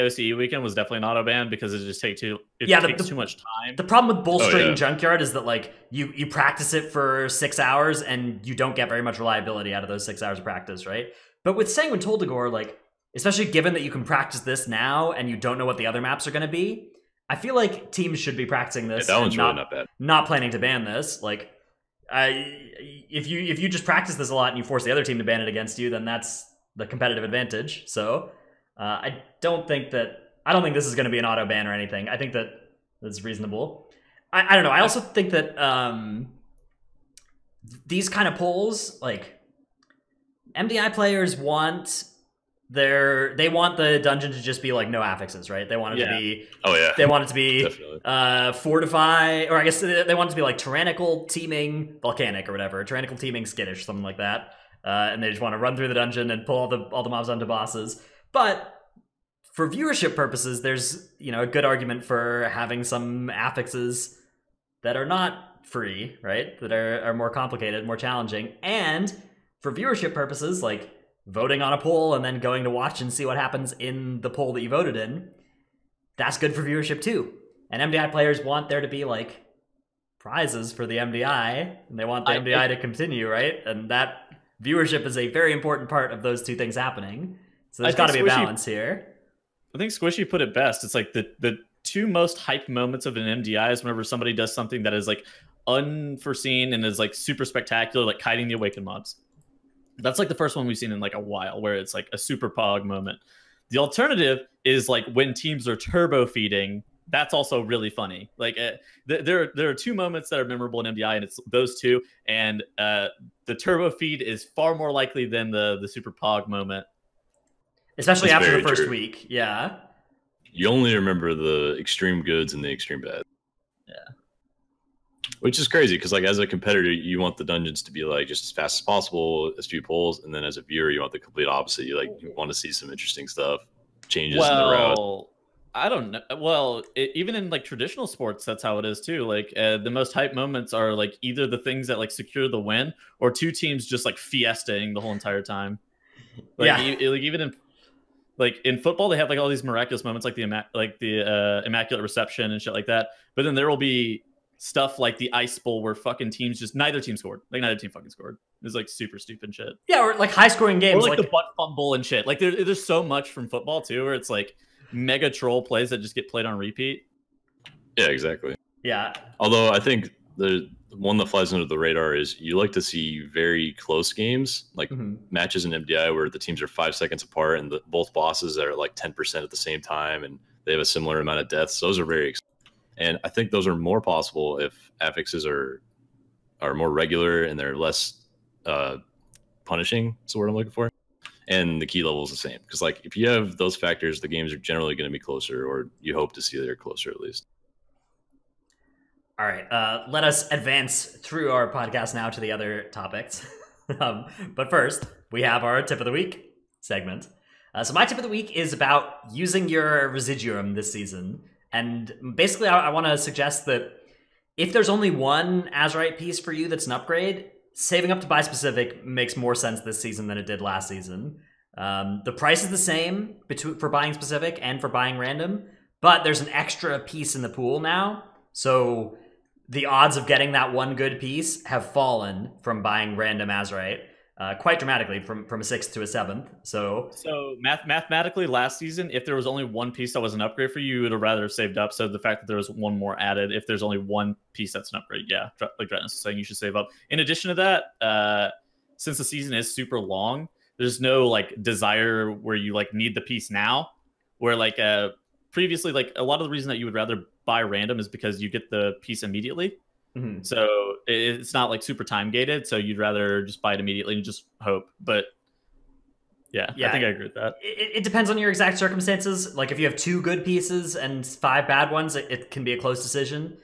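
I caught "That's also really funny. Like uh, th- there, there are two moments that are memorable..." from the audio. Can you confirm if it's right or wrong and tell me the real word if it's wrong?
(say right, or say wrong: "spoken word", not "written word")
right.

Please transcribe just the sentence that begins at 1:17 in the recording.
And MDI players want there to be like prizes for the MDI, and they want the I, MDI it, to continue, right?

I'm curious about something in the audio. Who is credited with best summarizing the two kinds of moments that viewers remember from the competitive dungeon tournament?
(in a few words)
Squishy.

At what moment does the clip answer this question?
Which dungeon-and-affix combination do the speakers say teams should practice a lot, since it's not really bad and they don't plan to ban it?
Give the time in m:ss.
0:11.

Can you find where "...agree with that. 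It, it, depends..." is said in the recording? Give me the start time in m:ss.
4:27.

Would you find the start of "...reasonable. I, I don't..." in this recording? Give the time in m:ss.
0:33.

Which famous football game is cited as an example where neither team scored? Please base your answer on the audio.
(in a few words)
the Ice Bowl.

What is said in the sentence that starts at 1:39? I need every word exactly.
That's like the first one we've seen in like a while where it's like a super pog moment.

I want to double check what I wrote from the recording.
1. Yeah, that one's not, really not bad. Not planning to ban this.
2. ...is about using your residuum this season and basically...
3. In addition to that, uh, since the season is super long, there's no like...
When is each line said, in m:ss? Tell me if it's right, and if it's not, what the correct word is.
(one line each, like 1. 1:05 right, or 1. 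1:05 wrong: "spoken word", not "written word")
1. 0:19 right
2. 3:28 right
3. 4:07 right.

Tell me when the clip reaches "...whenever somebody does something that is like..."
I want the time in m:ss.
1:33.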